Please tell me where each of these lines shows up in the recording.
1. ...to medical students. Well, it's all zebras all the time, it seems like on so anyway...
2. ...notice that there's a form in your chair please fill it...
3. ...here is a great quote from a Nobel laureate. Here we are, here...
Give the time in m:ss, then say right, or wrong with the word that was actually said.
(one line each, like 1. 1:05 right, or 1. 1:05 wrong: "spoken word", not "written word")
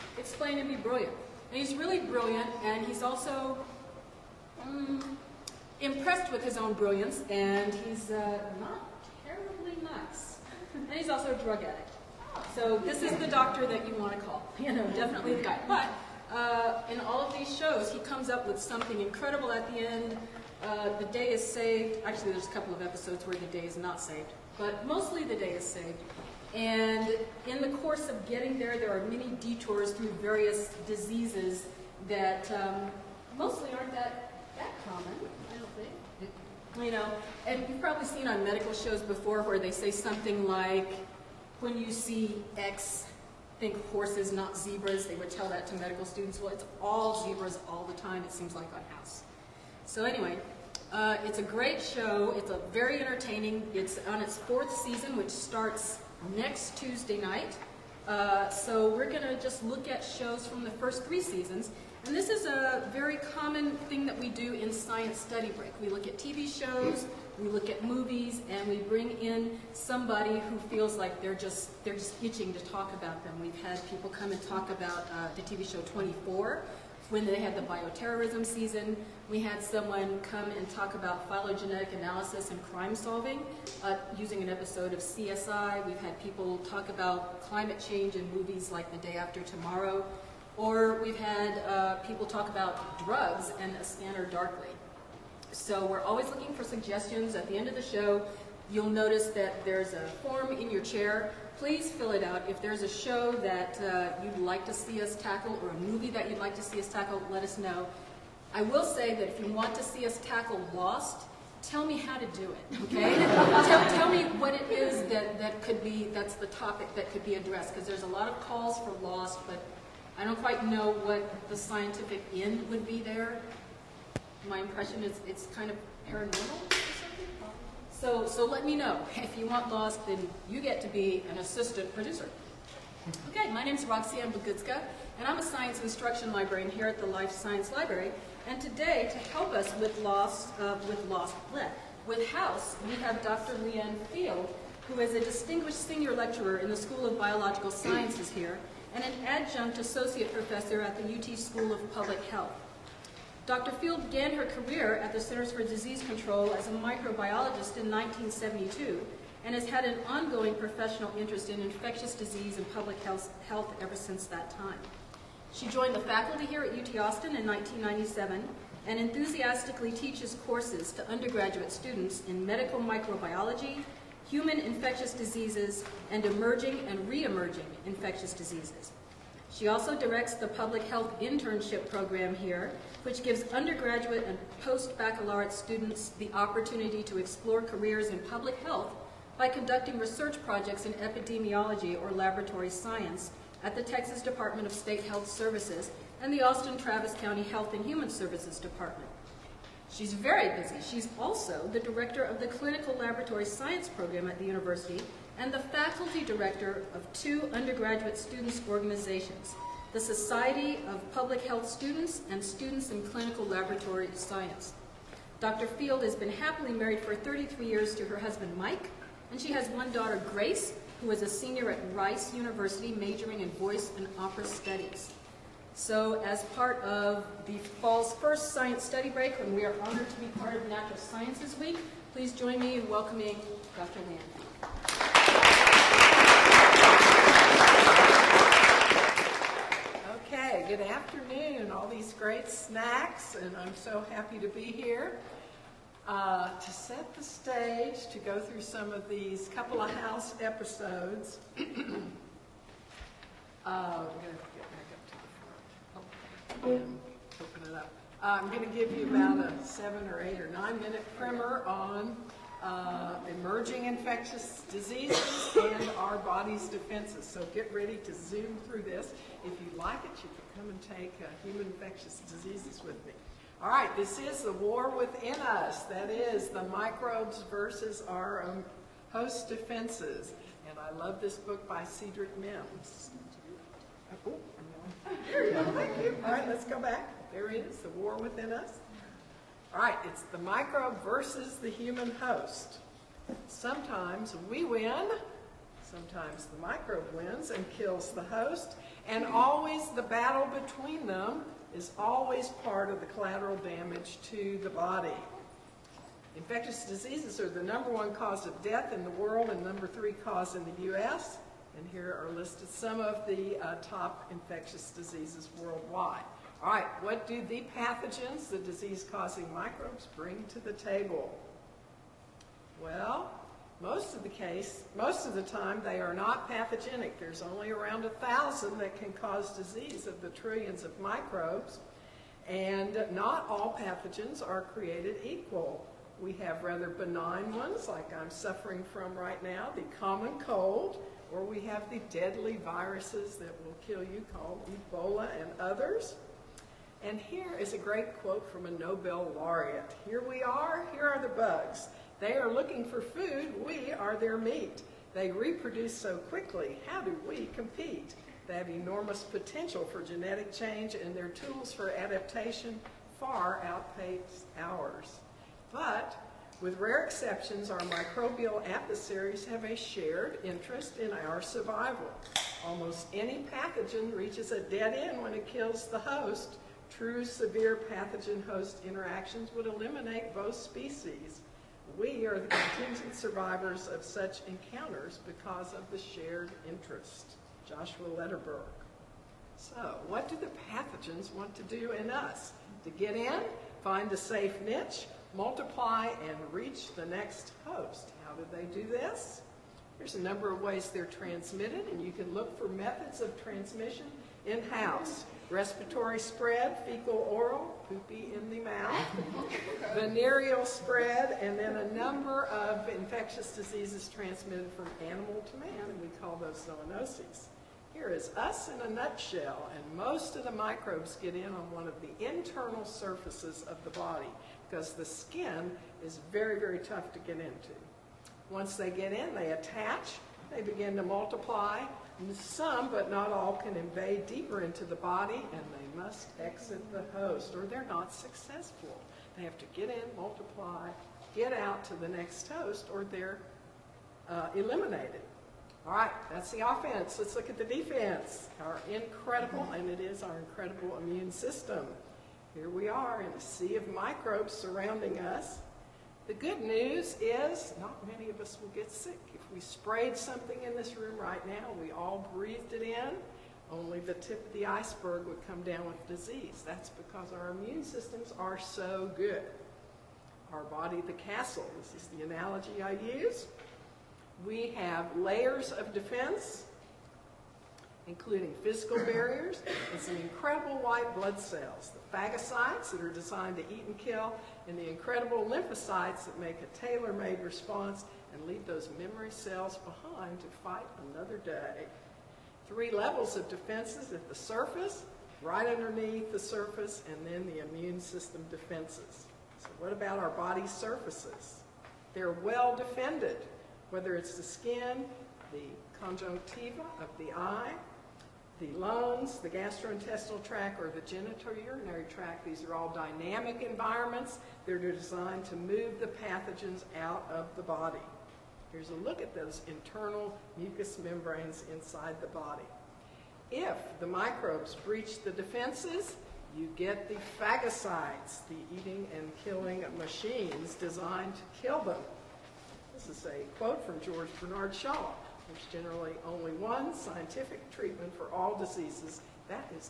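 1. 0:45 right
2. 1:38 right
3. 5:47 right.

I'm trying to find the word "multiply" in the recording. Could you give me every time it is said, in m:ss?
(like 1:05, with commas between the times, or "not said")
6:35, 7:11, 7:20.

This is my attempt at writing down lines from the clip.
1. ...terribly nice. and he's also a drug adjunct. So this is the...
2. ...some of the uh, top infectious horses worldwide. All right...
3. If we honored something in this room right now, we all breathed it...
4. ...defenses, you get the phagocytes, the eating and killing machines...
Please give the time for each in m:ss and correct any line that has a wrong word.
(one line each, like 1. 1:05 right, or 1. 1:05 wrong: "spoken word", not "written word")
1. 0:09 wrong: "addict", not "adjunct"
2. 5:12 wrong: "diseases", not "horses"
3. 7:39 wrong: "sprayed", not "honored"
4. 8:45 right.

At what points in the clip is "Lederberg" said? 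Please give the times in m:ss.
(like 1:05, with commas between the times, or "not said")
6:28.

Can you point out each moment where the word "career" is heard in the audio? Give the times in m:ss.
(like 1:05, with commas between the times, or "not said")
2:34, 3:07.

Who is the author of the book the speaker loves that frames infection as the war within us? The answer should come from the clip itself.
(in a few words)
Cedric Mims.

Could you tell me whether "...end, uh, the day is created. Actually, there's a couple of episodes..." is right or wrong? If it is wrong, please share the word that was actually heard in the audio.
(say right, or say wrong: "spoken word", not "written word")
wrong: "saved", not "created".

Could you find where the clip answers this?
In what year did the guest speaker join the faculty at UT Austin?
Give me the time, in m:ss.
2:47.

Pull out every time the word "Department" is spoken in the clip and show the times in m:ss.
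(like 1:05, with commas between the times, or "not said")
3:14, 3:18.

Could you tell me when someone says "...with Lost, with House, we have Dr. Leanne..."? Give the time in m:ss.
2:20.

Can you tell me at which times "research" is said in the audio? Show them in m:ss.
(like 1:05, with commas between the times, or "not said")
3:09.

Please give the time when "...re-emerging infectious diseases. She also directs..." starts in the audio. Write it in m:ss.
2:57.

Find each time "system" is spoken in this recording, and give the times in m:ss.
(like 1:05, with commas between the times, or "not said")
7:31, 7:47, 8:17.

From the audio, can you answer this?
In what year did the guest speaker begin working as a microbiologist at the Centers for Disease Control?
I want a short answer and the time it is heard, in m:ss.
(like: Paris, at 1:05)
1972, at 2:37.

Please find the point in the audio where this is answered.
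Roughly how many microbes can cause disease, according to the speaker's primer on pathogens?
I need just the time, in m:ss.
5:28.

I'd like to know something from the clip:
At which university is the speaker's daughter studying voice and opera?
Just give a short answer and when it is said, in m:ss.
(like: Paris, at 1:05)
Rice University, at 3:41.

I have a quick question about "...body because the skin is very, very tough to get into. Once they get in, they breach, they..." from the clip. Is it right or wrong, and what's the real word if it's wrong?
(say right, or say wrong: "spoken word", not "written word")
wrong: "attach", not "breach".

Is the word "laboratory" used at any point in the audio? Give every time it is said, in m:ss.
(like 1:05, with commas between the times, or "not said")
3:12, 3:22, 3:33.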